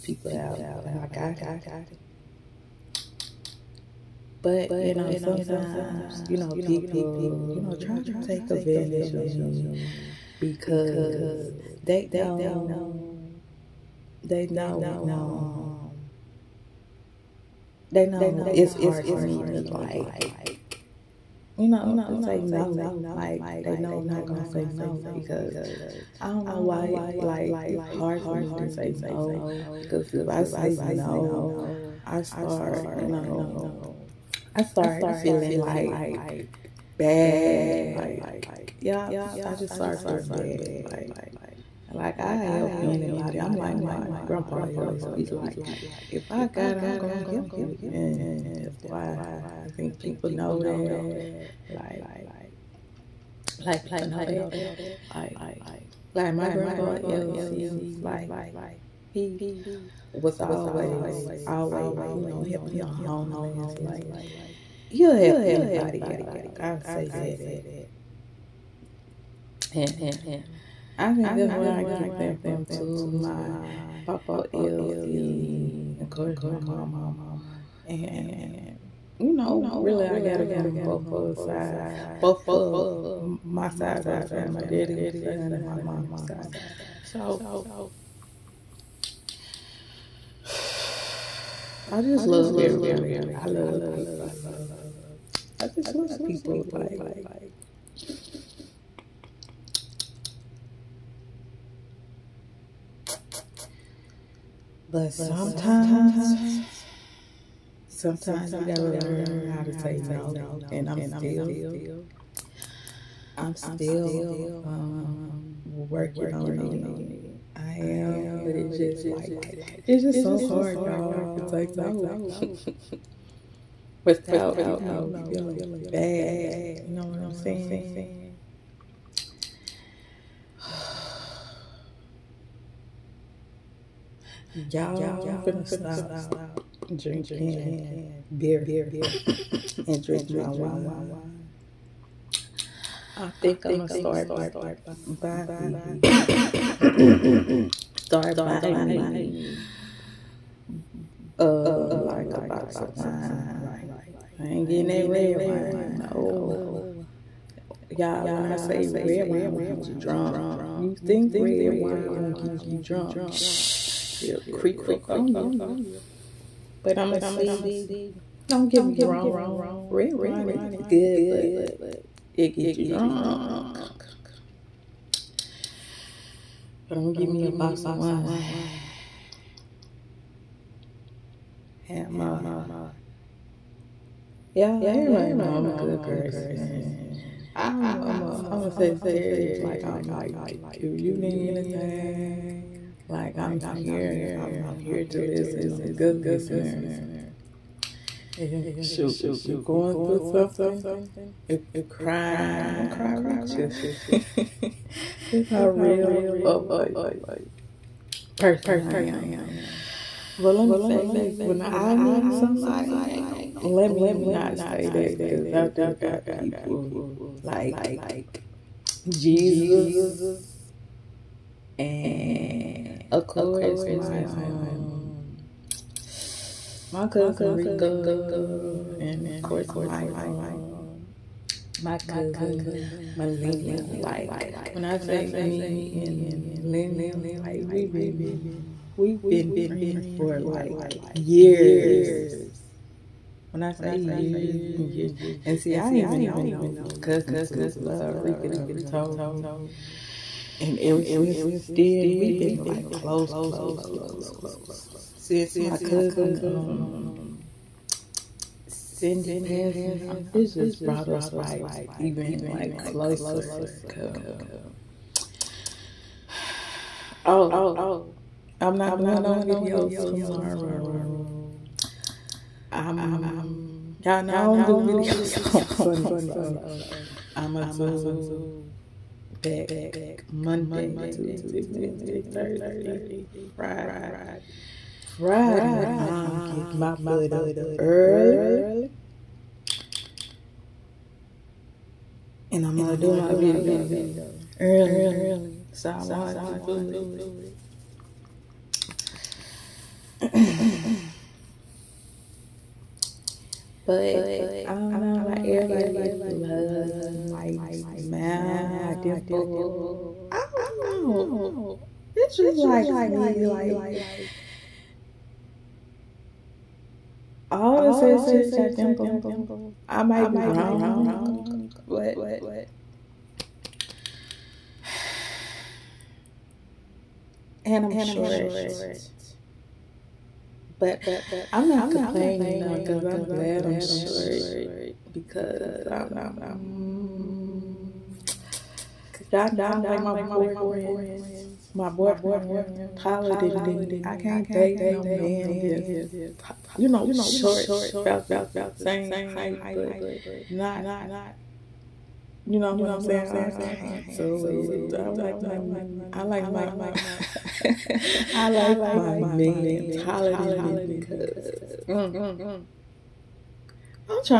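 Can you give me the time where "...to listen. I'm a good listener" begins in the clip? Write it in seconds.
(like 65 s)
195 s.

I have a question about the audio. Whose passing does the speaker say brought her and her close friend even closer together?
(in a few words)
Cindy.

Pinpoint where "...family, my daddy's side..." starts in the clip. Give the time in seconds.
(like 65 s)
84 s.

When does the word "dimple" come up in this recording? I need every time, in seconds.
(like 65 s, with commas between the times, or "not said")
308 s, 318 s.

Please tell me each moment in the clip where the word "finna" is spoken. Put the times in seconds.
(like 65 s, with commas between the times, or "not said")
135 s.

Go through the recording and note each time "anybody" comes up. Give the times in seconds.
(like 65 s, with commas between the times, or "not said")
42 s, 65 s.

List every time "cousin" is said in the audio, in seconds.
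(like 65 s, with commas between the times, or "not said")
227 s, 231 s, 246 s, 255 s.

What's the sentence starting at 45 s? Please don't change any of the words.
He like, if I got it, I'm gonna help you, and that's why I think people know that.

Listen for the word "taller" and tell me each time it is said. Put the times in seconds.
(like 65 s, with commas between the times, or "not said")
342 s, 359 s.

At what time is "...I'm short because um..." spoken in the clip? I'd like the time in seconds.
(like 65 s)
333 s.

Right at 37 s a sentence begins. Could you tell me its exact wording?
Like, yeah, I just start feeling bad.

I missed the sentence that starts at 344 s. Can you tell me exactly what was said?
I can't date no man that's you know short about the same height but not you know what I'm saying?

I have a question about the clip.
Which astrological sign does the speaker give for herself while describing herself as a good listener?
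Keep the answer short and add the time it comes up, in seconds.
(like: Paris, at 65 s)
Sagittarius, at 188 s.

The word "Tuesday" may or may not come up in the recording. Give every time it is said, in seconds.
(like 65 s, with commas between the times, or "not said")
281 s.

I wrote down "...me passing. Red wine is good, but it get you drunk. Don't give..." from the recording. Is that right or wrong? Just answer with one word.
wrong.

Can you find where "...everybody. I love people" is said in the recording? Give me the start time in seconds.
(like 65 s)
92 s.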